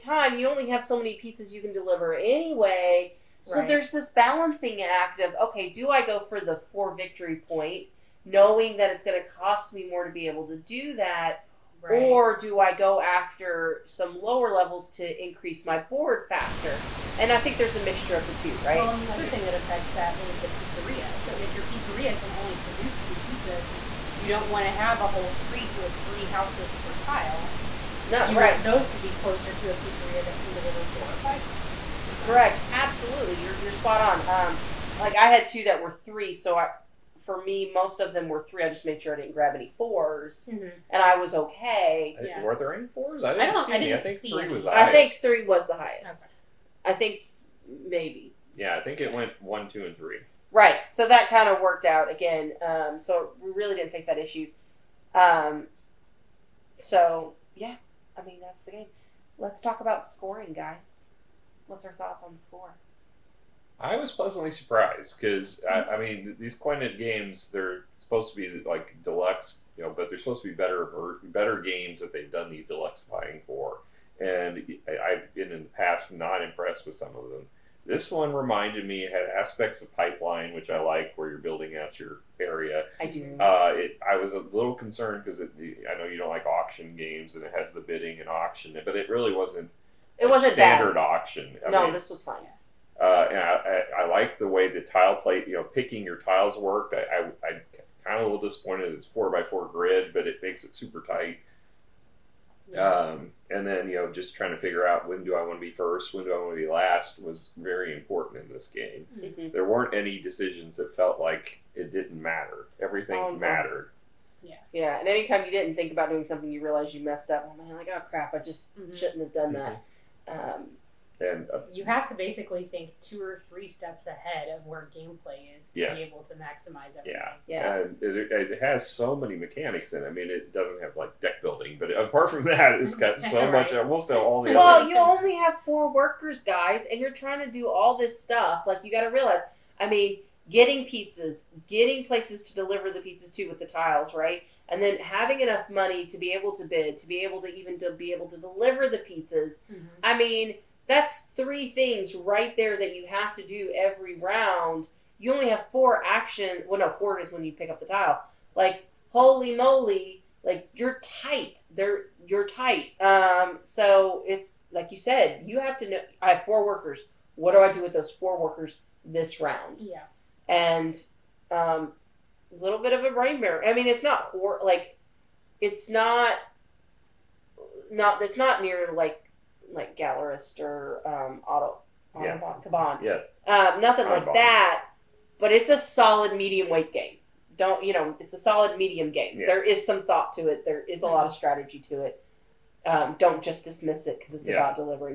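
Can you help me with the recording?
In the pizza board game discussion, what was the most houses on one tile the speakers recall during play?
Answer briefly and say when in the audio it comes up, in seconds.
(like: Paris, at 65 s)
3, at 44 s.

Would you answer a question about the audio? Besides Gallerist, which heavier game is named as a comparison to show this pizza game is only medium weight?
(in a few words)
Kanban.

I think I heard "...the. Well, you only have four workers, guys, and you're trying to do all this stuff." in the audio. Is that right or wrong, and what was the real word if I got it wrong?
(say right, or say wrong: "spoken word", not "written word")
right.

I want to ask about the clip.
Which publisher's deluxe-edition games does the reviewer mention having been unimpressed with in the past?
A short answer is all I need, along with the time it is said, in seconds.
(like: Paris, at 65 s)
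Quined, at 66 s.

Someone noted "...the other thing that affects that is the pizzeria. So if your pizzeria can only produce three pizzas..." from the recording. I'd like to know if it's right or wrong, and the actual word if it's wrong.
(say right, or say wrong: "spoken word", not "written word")
wrong: "two", not "three".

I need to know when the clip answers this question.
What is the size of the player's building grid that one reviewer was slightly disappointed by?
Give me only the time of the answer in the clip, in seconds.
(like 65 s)
99 s.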